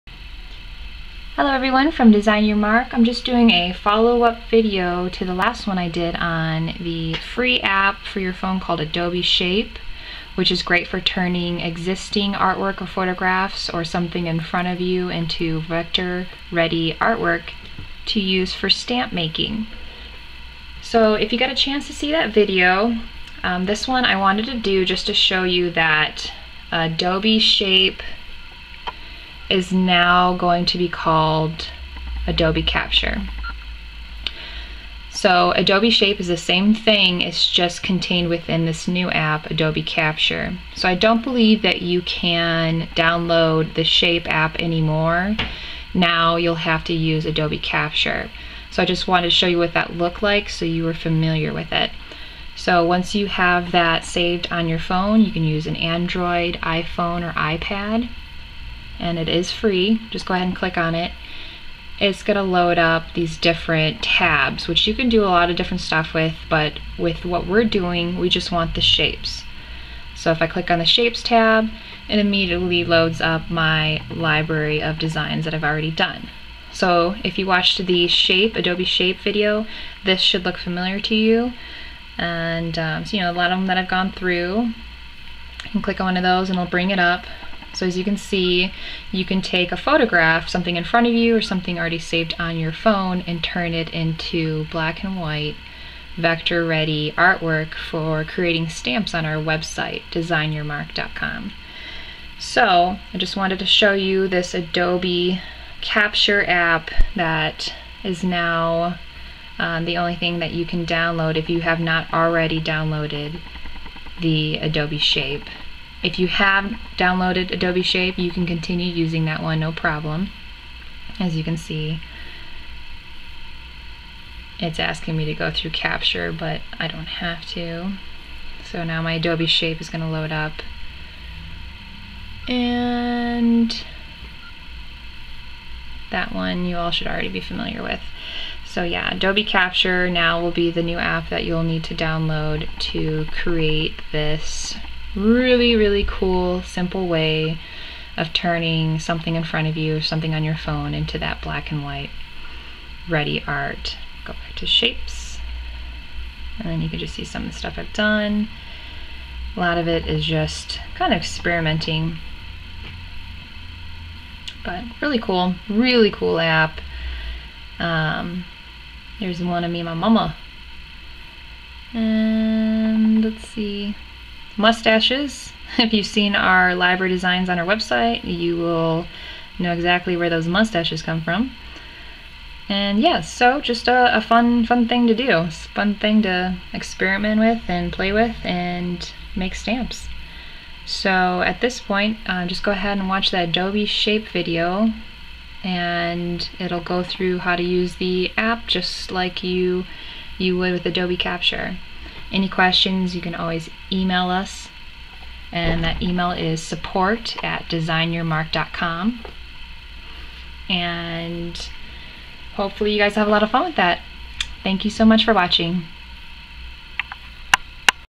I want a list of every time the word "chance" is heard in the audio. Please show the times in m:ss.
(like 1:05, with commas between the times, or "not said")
0:21.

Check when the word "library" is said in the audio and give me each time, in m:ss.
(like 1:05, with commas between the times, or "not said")
1:14, 2:56.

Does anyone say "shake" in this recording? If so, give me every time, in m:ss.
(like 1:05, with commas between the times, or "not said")
not said.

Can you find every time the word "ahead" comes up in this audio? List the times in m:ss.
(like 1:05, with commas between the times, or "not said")
1:00, 3:12.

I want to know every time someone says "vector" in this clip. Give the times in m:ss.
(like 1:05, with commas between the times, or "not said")
0:15, 1:36.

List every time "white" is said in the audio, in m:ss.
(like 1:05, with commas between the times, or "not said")
1:35, 2:31.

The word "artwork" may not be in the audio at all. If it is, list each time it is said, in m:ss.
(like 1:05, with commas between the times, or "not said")
0:12, 0:16, 1:37.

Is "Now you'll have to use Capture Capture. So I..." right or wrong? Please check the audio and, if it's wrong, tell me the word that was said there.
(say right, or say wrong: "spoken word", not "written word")
wrong: "Adobe", not "Capture".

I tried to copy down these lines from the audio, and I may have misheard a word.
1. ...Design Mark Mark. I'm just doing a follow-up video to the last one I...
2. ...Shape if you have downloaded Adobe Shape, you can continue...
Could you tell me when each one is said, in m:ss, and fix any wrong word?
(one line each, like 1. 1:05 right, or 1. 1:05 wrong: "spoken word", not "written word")
1. 0:02 wrong: "Your", not "Mark"
2. 1:54 right.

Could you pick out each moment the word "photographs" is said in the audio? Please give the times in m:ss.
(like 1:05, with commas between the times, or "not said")
0:12, 1:29.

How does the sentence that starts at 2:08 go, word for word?
So now my Adobe Shape is going to load up.